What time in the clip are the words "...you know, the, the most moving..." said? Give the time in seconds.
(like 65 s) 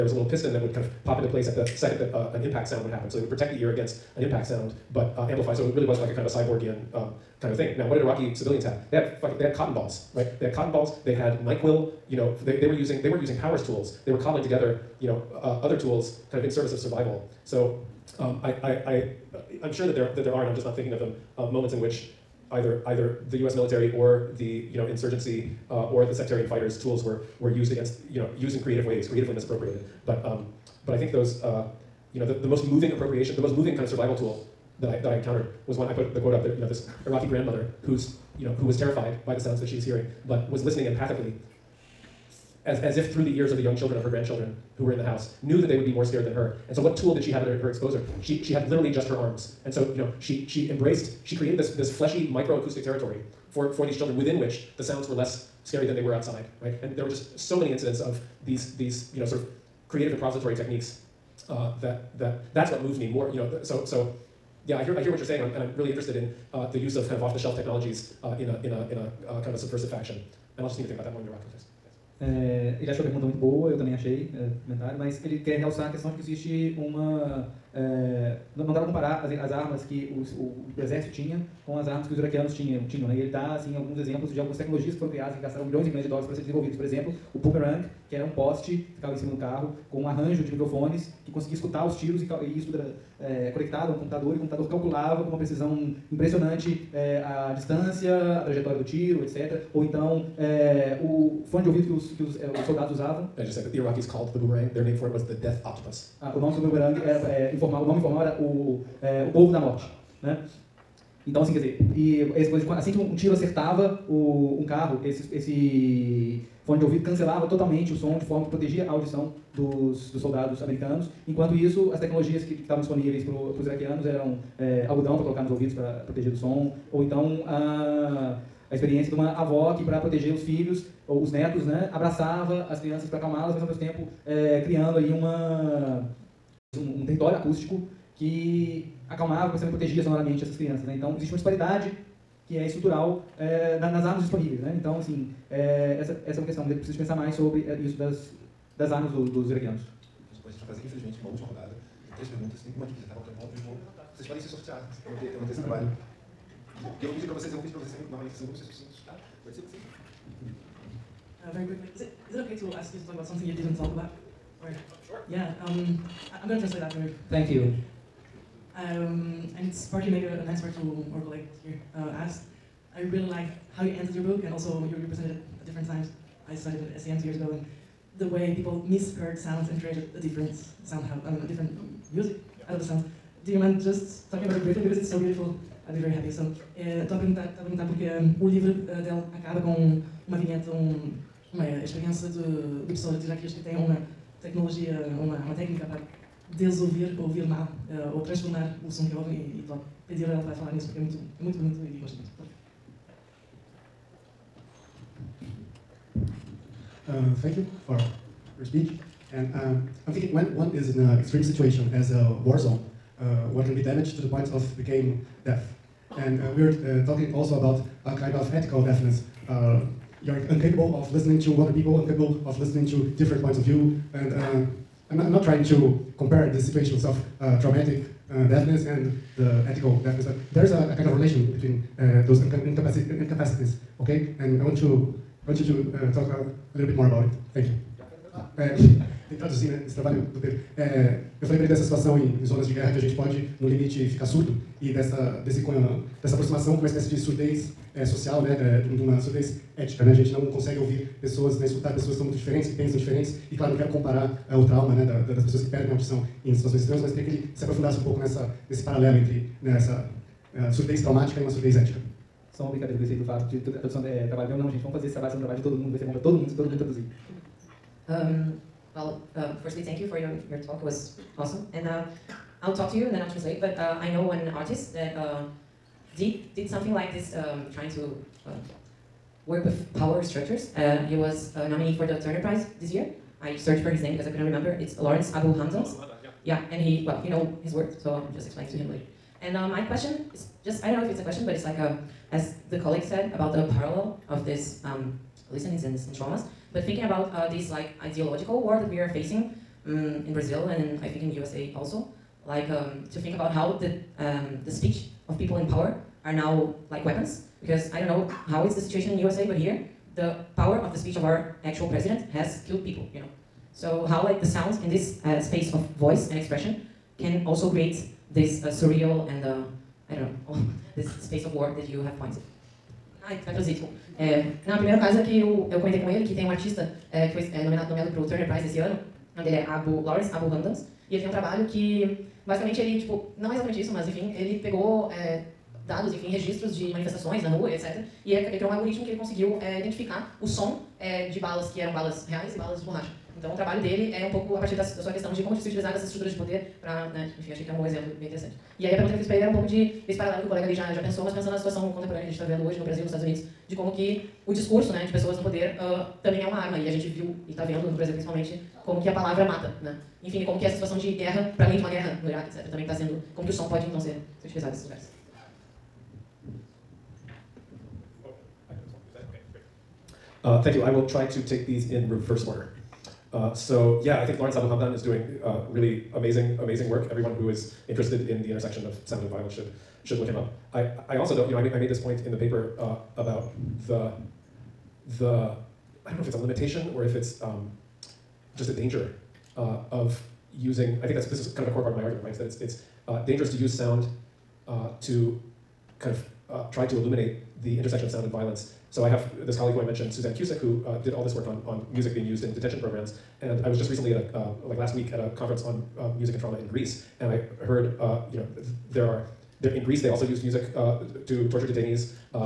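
32 s.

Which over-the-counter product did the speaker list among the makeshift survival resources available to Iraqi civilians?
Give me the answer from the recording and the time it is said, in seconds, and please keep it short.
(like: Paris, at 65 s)
Nyquil, at 11 s.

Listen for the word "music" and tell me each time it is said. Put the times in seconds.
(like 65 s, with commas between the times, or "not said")
182 s, 401 s, 406 s, 410 s.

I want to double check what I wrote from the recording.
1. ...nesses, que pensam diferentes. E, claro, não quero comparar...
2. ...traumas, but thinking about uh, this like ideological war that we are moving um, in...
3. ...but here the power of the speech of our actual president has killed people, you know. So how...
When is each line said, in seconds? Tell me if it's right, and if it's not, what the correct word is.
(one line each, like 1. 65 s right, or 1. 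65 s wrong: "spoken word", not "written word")
1. 252 s wrong: "diferentes", not "nesses"
2. 296 s wrong: "facing", not "moving"
3. 309 s right.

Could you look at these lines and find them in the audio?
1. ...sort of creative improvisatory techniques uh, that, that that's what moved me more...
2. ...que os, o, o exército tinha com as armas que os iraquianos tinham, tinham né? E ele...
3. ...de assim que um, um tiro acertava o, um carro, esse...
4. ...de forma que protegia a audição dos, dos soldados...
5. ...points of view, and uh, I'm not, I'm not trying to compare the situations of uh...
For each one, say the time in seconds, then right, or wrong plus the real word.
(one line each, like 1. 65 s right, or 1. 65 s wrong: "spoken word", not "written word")
1. 59 s right
2. 79 s right
3. 112 s right
4. 118 s right
5. 223 s right.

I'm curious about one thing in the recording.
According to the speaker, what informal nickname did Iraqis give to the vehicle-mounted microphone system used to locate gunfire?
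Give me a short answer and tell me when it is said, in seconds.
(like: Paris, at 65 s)
the death octopus, at 105 s.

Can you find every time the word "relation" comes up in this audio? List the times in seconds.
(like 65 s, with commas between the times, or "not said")
231 s.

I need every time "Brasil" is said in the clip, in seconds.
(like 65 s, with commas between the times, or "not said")
352 s, 357 s.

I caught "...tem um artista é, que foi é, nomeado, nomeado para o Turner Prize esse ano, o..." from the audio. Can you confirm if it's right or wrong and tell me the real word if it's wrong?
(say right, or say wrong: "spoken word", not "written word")
right.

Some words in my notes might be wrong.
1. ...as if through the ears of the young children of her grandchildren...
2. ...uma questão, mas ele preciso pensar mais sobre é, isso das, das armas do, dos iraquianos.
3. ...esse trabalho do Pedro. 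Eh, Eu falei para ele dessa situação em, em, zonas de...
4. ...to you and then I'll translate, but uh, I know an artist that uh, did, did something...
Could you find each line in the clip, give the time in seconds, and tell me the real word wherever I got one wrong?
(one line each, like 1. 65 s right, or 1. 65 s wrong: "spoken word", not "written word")
1. 42 s right
2. 146 s right
3. 239 s right
4. 272 s right.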